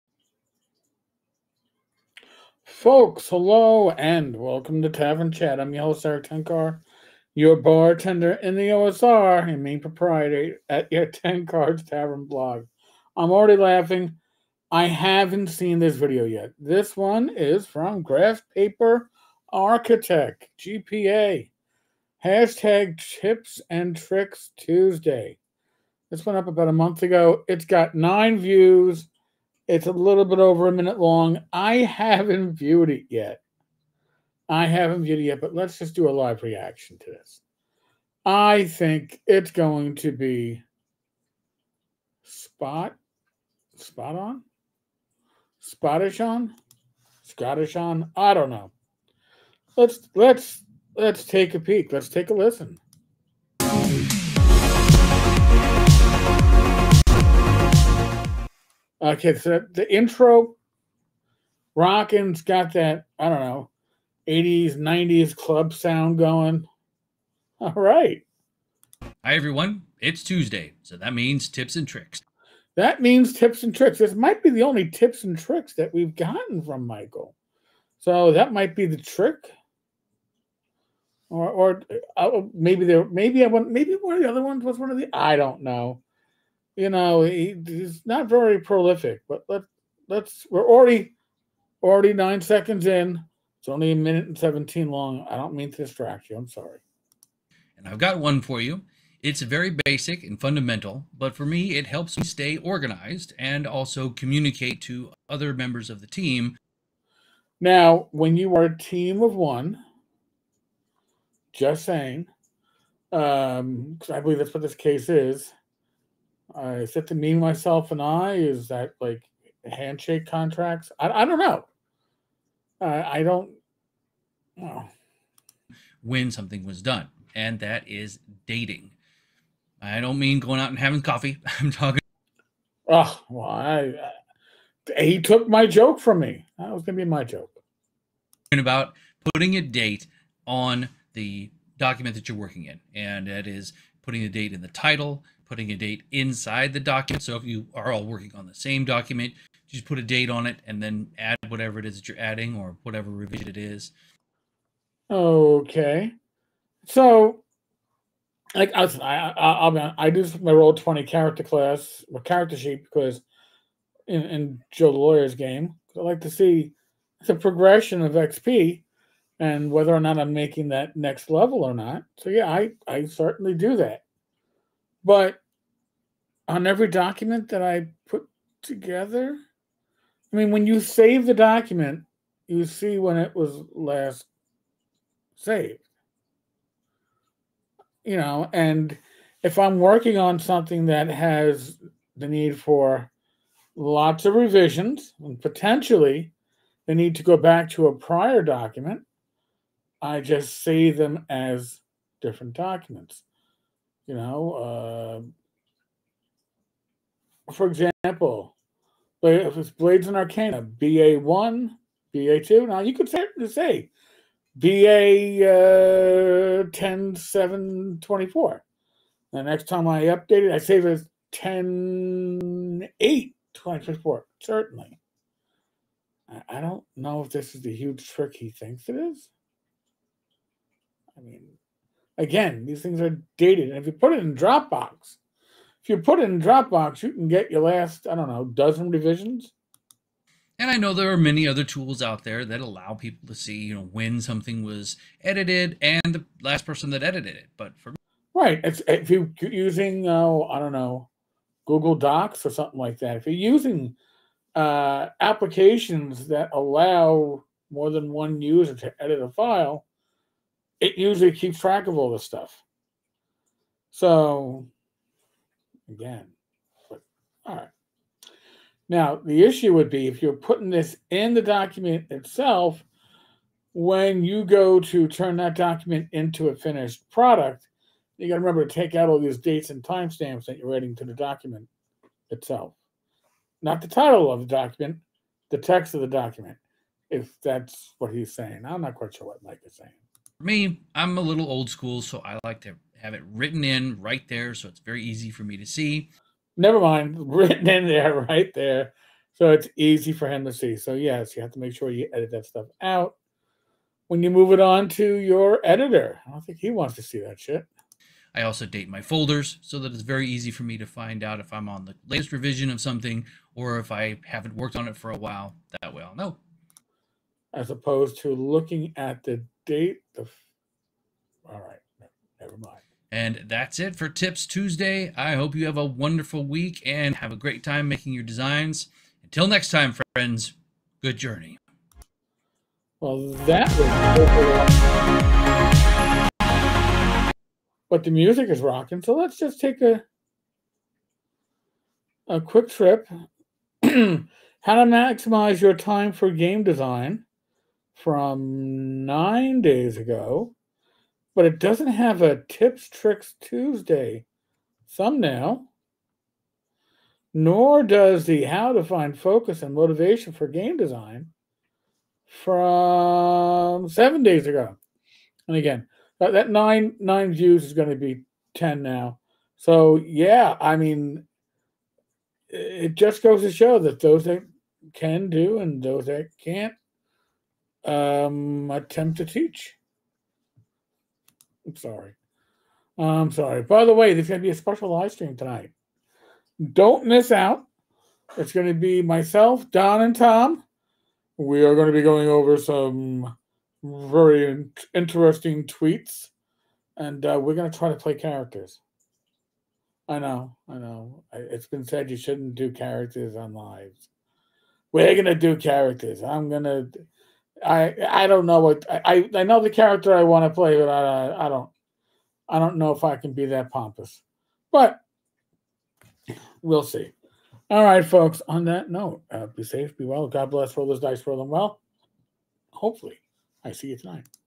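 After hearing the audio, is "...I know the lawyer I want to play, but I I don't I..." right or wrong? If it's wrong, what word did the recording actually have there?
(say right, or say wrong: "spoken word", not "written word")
wrong: "character", not "lawyer".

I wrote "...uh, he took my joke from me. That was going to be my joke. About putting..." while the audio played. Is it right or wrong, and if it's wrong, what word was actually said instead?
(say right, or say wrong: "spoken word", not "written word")
right.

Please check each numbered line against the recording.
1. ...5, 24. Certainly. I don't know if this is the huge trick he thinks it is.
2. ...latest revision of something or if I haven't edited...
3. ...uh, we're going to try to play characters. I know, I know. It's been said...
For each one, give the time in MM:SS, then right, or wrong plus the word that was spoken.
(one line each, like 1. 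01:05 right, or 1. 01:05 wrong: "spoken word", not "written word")
1. 03:42 wrong: "8", not "5"
2. 05:12 wrong: "worked", not "edited"
3. 06:37 right.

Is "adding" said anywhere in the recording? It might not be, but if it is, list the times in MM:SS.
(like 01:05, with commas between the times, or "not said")
02:32, 04:40.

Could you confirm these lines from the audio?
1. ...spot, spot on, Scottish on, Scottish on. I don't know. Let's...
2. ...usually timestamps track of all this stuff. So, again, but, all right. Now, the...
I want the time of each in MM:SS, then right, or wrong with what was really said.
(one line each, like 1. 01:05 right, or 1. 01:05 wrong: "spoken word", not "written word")
1. 00:42 right
2. 04:20 wrong: "keeps", not "timestamps".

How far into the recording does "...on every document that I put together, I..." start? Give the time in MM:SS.
02:56.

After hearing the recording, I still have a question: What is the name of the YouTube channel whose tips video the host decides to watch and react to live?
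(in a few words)
Graph Paper Architect.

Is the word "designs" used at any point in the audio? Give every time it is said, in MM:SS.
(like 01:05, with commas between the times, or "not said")
05:28, 05:46, 06:00.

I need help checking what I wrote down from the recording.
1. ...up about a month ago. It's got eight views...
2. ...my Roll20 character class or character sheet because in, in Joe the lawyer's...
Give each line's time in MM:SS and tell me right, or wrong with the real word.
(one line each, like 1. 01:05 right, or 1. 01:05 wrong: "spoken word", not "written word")
1. 00:26 wrong: "nine", not "eight"
2. 02:40 right.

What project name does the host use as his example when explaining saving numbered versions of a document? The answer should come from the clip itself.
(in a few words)
Blades and Arcana.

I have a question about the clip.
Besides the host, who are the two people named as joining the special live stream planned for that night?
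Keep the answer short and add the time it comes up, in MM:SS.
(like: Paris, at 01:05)
Don and Tom, at 06:29.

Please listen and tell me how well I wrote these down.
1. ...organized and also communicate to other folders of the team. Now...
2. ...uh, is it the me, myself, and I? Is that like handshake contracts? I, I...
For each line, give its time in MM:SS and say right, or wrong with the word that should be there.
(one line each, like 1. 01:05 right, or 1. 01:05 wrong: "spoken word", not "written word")
1. 01:42 wrong: "members", not "folders"
2. 01:56 right.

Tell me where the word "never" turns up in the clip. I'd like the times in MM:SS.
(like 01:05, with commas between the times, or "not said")
04:56, 05:22.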